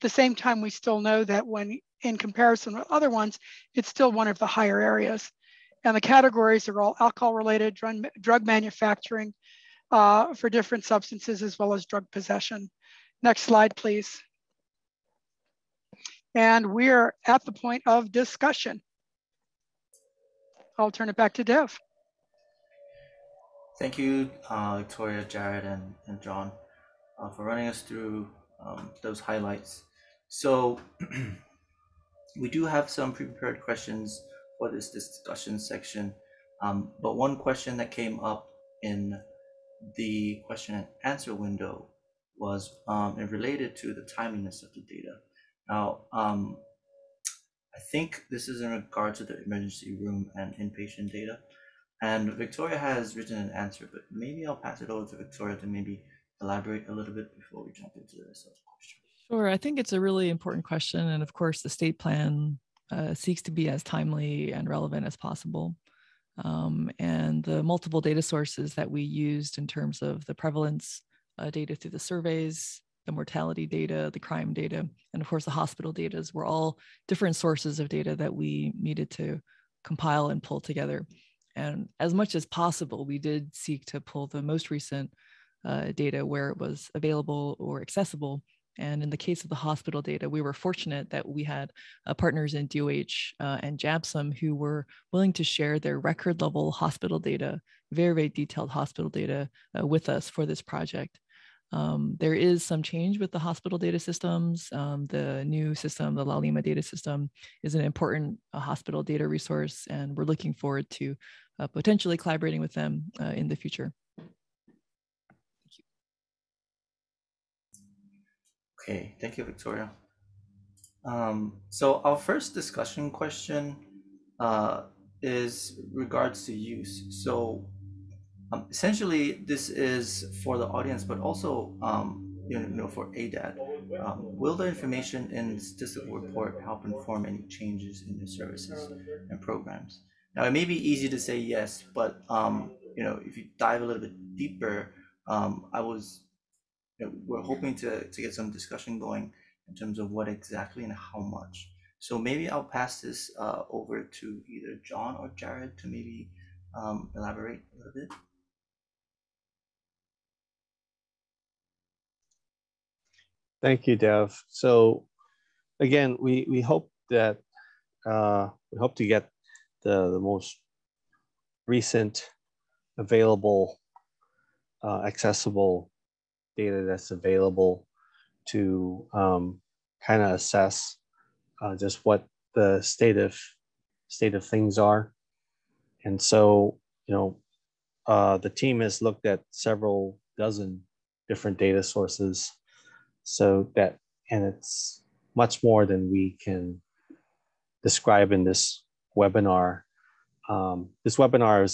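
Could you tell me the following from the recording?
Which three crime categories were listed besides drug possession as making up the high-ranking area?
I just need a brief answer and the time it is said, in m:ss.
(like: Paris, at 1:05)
alcohol related, drug, drug manufacturing, at 0:06.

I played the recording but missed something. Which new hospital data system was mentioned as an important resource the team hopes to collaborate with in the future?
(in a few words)
Laulima.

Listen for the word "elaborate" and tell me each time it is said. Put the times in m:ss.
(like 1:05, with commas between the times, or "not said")
0:56, 2:37.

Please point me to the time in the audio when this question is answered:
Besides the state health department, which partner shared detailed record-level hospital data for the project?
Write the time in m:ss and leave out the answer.
1:33.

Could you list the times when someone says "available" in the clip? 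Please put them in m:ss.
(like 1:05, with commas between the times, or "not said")
1:26, 2:52, 2:57.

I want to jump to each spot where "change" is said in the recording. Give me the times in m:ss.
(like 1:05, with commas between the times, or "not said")
1:42, 2:17.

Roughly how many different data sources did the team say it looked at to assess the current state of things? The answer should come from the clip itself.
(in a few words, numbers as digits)
several dozen.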